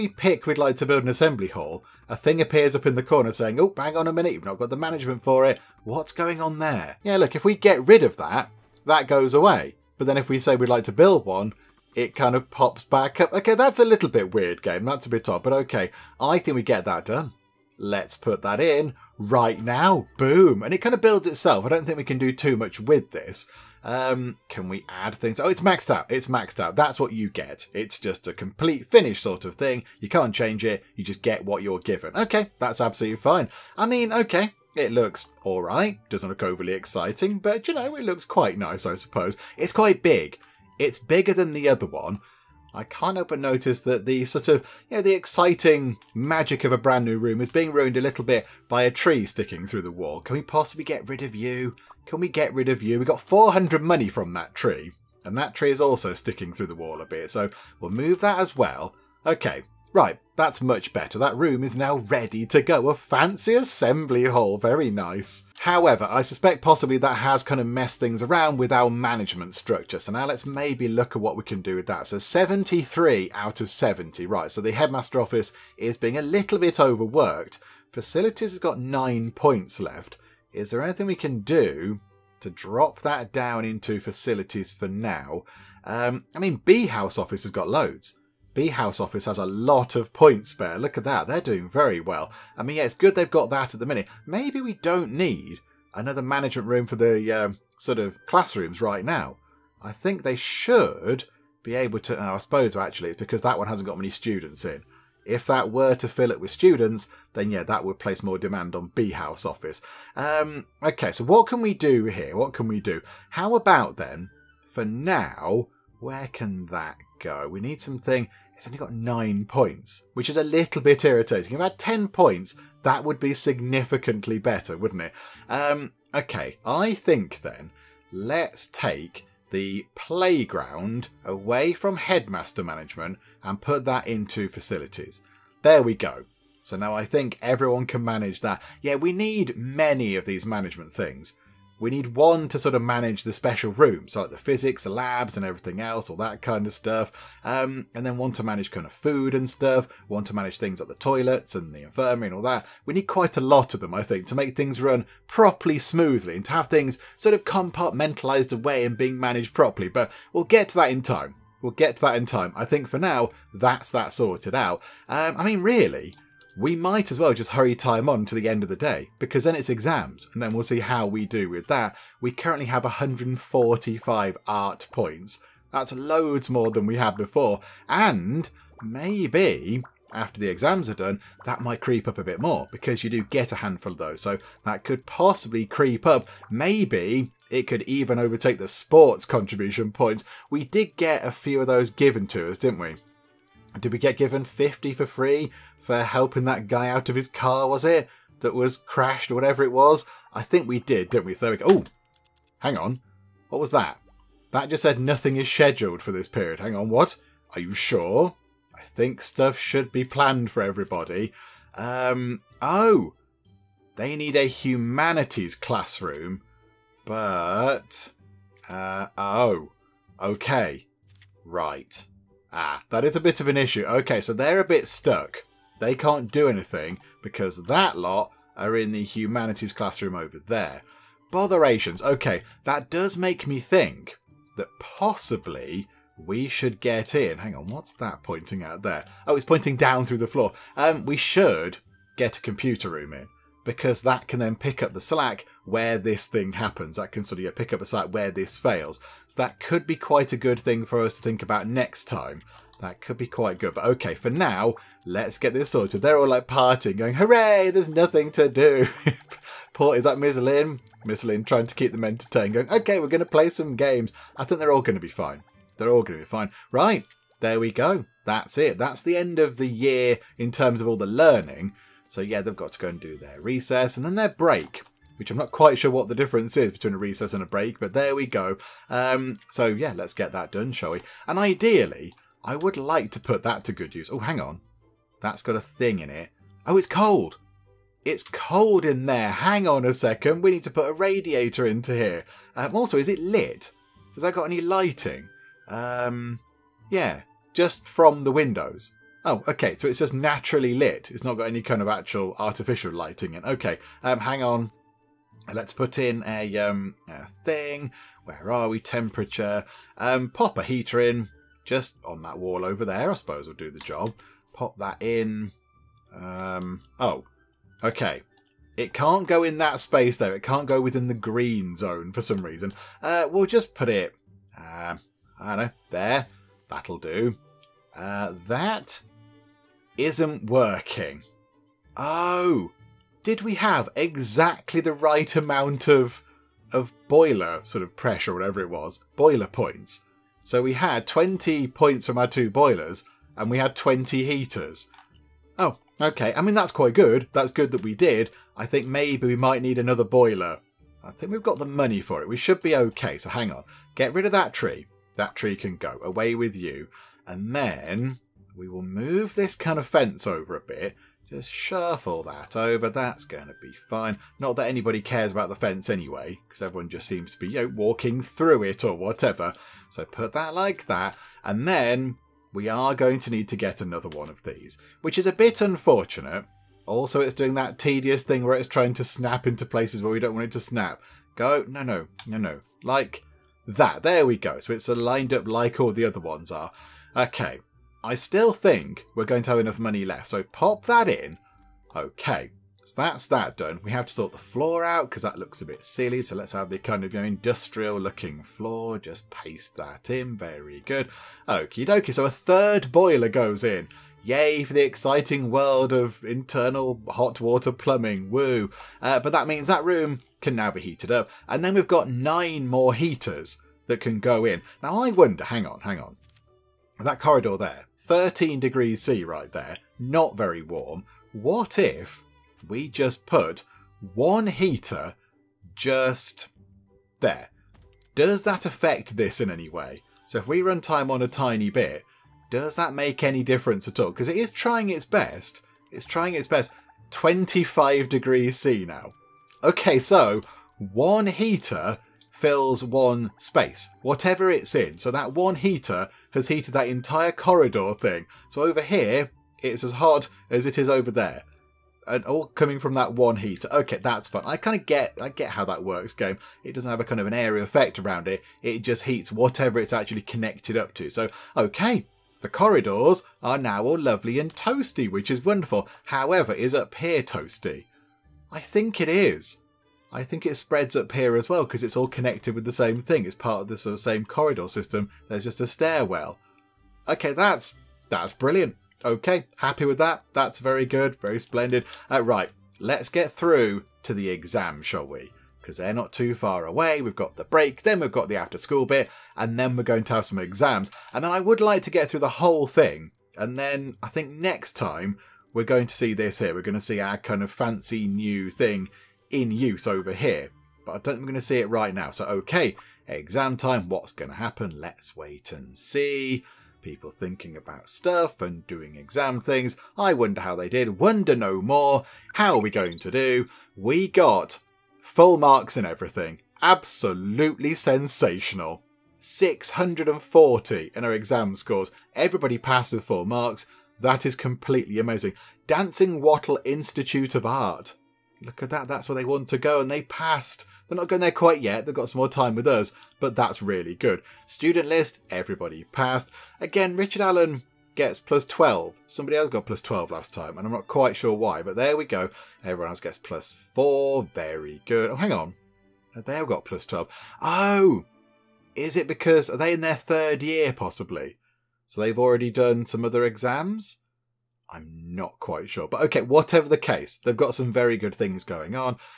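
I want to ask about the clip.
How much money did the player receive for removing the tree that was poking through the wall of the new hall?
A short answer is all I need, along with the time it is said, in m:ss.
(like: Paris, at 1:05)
400, at 0:53.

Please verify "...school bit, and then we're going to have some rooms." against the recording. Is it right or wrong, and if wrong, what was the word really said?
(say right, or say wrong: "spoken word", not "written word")
wrong: "exams", not "rooms".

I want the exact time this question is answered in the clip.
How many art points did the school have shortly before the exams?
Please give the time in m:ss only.
2:52.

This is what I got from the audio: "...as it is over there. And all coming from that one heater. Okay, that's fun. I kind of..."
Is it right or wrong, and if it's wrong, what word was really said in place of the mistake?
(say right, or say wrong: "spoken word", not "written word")
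right.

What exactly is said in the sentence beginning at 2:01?
If I had 10 points, that would be significantly better, wouldn't it?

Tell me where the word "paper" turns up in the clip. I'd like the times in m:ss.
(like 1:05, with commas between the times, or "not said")
not said.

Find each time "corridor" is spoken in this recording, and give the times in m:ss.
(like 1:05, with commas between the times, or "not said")
6:57, 7:27, 7:42, 7:54.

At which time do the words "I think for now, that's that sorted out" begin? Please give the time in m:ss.
2:42.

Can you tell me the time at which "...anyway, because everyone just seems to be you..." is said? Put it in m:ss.
6:05.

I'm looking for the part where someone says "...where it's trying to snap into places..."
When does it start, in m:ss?
6:18.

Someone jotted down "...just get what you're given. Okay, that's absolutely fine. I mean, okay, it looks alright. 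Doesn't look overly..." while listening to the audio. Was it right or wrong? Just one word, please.
right.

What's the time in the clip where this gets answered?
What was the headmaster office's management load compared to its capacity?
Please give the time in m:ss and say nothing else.
1:12.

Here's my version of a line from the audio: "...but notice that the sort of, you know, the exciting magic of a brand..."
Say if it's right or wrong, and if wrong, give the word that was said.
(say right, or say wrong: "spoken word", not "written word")
right.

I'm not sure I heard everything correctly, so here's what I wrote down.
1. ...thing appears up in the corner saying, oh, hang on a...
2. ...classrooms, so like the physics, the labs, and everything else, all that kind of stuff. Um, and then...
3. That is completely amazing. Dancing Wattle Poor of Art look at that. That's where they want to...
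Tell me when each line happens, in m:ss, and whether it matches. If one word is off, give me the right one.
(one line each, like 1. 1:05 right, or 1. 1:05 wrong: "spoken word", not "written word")
1. 0:02 right
2. 2:23 wrong: "rooms", not "classrooms"
3. 8:44 wrong: "Institute", not "Poor".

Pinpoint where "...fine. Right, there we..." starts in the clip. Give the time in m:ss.
4:26.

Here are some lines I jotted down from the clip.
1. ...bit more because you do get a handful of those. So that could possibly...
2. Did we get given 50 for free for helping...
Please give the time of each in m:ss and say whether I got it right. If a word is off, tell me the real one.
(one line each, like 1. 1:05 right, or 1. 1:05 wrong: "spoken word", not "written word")
1. 3:02 right
2. 3:13 right.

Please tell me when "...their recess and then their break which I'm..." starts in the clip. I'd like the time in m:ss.
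4:33.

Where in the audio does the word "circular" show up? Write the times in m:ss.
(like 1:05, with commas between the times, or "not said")
not said.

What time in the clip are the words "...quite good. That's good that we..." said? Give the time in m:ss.
5:46.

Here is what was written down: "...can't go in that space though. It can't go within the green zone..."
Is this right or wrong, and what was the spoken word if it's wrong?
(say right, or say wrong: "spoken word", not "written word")
right.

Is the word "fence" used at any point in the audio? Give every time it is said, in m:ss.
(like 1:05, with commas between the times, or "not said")
5:59, 6:05.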